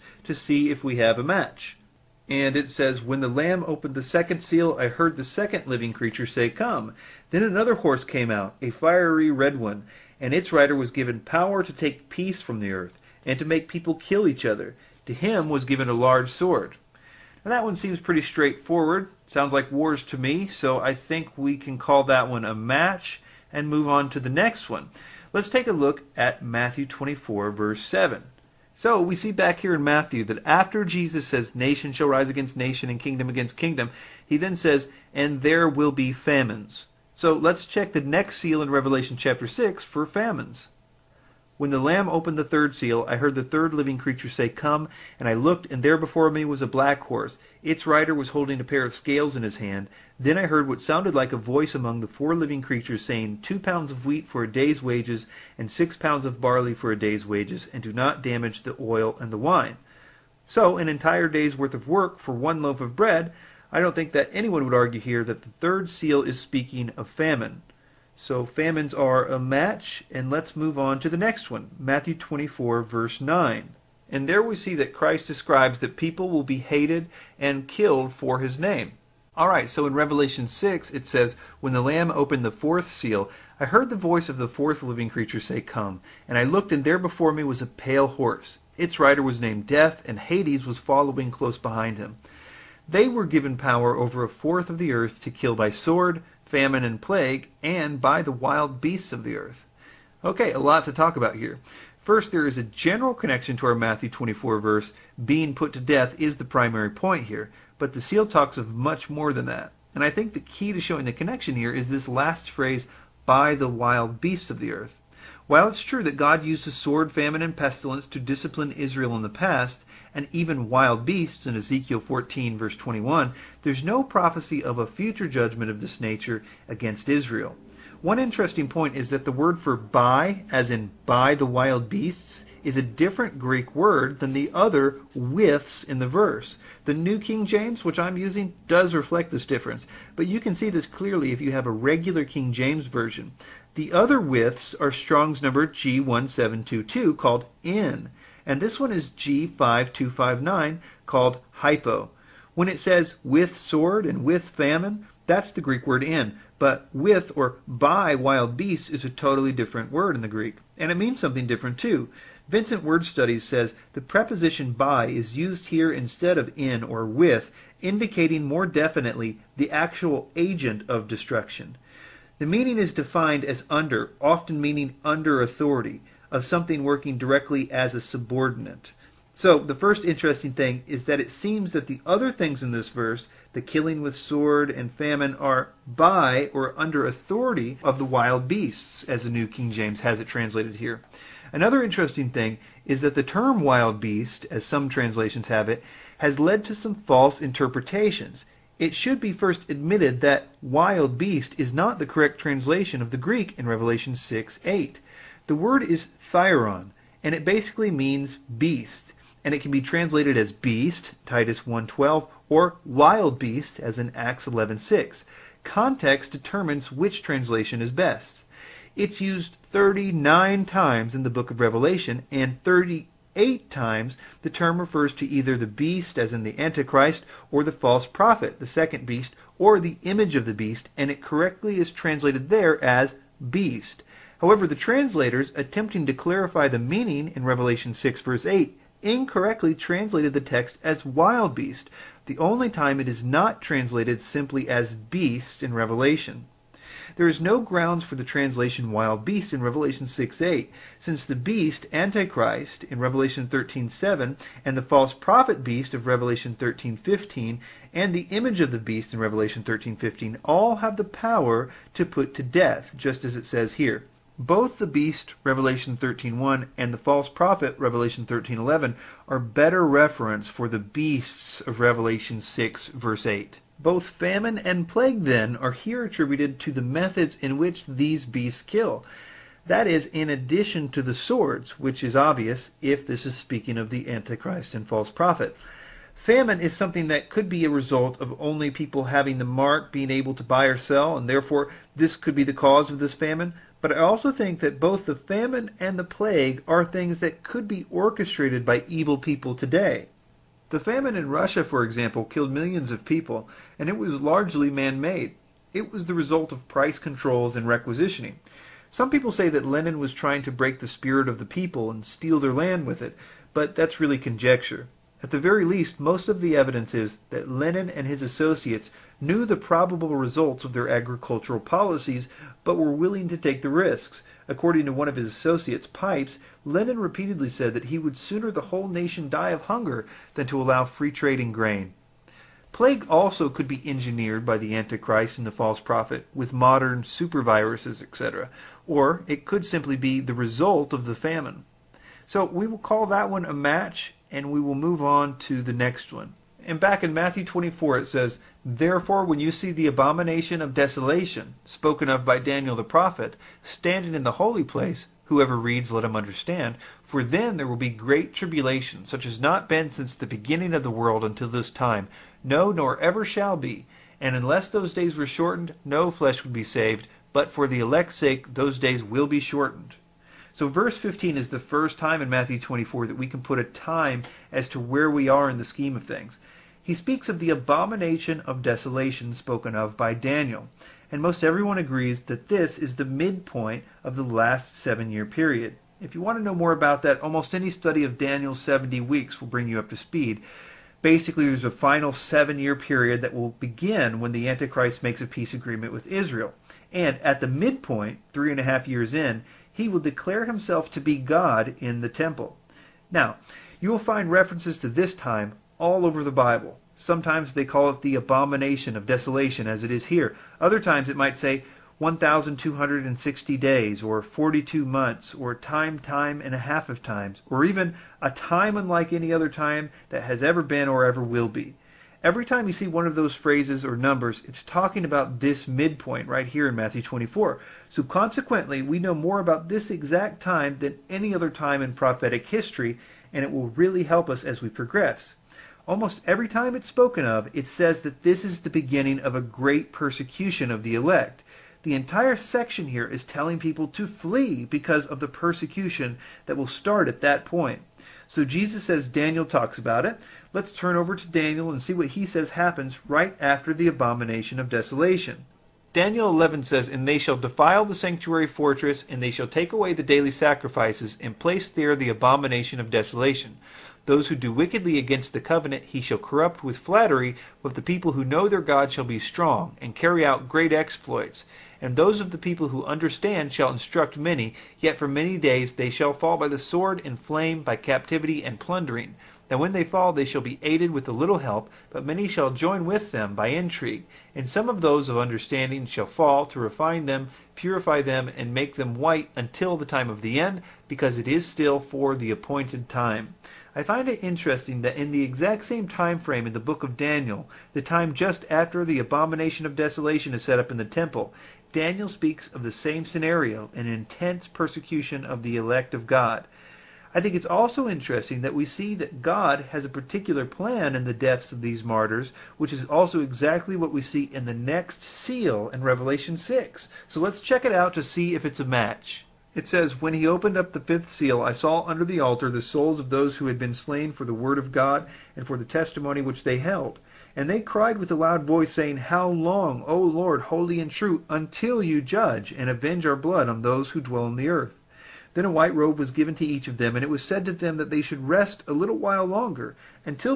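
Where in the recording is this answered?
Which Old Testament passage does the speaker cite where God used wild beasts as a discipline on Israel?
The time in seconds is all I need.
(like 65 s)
121 s.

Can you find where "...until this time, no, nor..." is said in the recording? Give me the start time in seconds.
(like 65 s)
361 s.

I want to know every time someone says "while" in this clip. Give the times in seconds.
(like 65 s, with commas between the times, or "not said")
115 s, 538 s.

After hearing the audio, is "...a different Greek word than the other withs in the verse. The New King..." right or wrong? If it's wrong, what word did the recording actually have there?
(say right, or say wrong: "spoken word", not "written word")
right.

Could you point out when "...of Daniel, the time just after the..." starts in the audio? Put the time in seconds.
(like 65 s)
496 s.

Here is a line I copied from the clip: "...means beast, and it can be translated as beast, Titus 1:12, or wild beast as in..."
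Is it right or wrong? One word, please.
right.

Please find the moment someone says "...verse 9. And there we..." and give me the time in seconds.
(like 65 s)
72 s.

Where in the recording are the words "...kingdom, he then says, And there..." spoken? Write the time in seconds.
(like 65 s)
33 s.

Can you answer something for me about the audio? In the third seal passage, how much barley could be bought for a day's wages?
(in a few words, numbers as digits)
6 pounds.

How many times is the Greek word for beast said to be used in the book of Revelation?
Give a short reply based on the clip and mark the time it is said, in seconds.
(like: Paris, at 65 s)
39, at 219 s.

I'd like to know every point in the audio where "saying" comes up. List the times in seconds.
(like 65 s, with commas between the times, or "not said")
53 s, 528 s.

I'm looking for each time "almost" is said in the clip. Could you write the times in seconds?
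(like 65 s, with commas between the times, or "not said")
387 s, 435 s.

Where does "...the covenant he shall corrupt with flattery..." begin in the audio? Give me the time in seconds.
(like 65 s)
465 s.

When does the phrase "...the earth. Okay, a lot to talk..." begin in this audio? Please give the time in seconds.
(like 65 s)
99 s.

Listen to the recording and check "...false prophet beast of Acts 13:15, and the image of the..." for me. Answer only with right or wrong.
wrong.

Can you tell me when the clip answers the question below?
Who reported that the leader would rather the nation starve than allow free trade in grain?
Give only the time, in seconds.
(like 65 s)
325 s.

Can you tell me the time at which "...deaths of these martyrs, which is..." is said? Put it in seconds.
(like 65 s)
511 s.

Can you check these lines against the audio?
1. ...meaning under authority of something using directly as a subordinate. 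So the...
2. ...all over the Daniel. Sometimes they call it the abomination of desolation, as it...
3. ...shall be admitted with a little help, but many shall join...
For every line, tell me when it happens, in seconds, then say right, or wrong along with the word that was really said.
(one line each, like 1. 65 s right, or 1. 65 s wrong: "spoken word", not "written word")
1. 174 s wrong: "working", not "using"
2. 405 s wrong: "Bible", not "Daniel"
3. 480 s wrong: "aided", not "admitted".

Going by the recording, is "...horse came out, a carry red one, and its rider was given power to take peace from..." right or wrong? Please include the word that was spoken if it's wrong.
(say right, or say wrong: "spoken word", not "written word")
wrong: "fiery", not "carry".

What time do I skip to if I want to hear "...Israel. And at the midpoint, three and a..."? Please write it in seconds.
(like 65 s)
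396 s.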